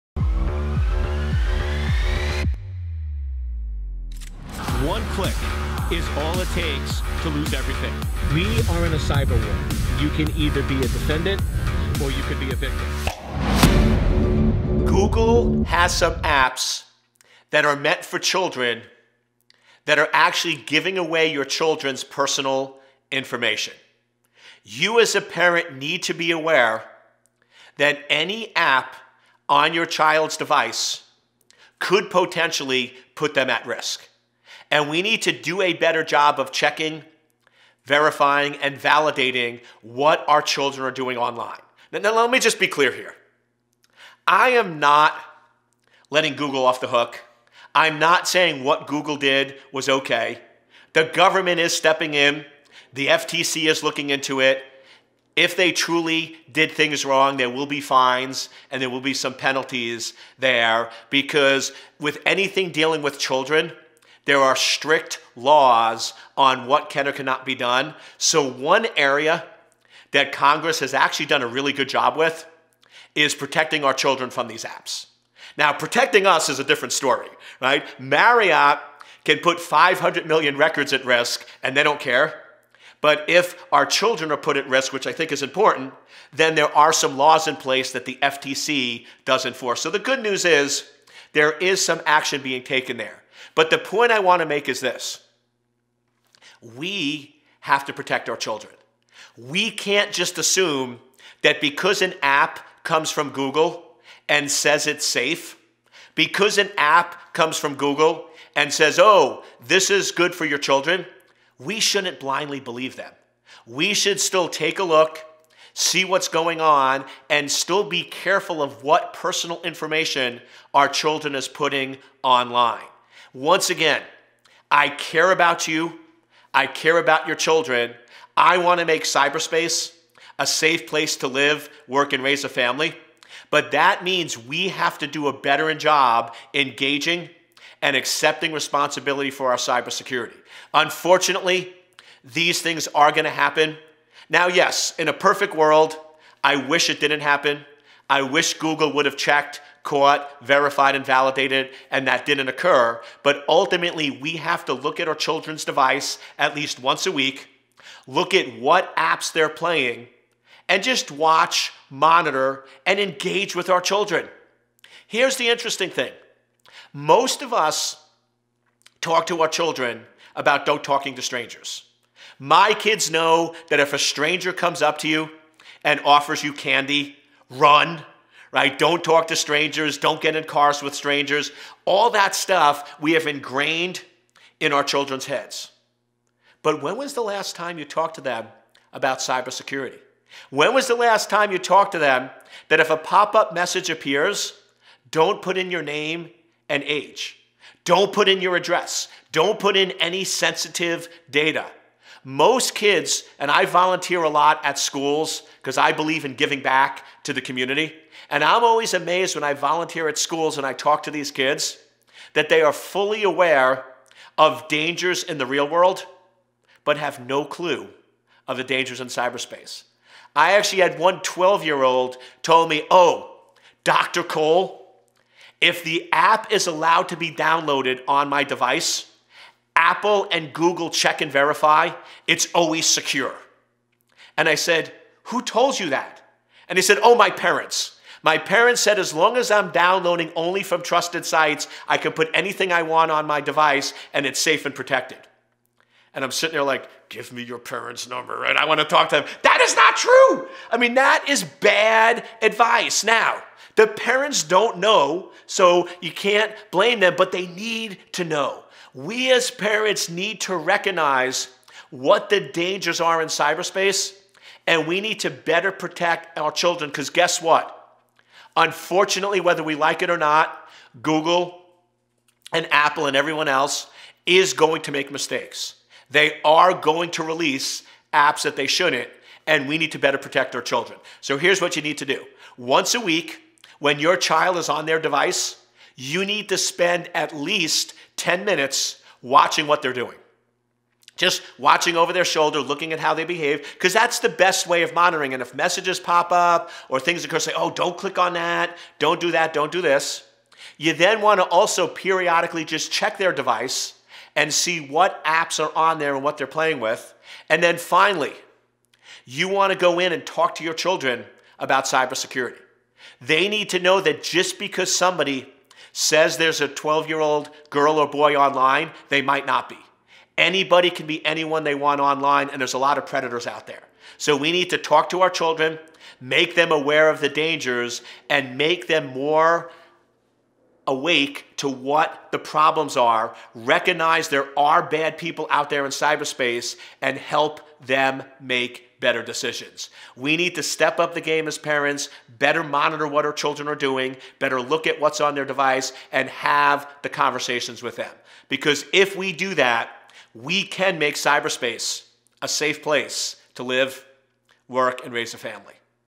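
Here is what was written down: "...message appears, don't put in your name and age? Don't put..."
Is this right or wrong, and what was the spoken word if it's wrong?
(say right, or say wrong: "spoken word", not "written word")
right.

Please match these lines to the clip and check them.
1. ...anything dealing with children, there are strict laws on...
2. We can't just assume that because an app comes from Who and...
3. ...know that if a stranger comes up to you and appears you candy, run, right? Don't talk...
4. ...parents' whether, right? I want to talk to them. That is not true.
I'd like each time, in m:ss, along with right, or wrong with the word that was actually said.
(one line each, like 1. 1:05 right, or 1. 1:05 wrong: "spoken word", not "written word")
1. 1:02 right
2. 1:39 wrong: "Google", not "Who"
3. 2:53 wrong: "offers", not "appears"
4. 4:07 wrong: "number", not "whether".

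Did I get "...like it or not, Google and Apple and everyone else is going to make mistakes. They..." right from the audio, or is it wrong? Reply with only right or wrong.
right.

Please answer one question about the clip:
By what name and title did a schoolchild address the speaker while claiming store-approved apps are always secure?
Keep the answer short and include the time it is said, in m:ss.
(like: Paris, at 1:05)
Dr. Cole, at 3:43.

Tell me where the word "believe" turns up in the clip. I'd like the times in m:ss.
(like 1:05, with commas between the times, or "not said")
1:52, 3:25.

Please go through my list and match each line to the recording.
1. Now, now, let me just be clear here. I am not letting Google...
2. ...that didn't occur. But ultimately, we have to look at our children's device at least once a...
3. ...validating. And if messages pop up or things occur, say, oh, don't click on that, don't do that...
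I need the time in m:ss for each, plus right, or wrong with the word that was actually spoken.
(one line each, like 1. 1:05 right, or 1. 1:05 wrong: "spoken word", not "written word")
1. 0:41 right
2. 2:32 right
3. 4:54 wrong: "monitoring", not "validating".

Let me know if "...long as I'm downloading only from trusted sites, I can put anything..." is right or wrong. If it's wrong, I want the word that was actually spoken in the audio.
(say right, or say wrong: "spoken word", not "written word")
right.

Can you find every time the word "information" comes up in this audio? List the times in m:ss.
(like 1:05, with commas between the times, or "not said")
0:23, 1:59.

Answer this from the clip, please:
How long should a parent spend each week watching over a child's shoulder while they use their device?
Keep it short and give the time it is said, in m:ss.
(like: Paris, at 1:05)
10 minutes, at 4:48.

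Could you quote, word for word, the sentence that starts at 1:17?
Marriott can put 500 million records at risk and they don't care.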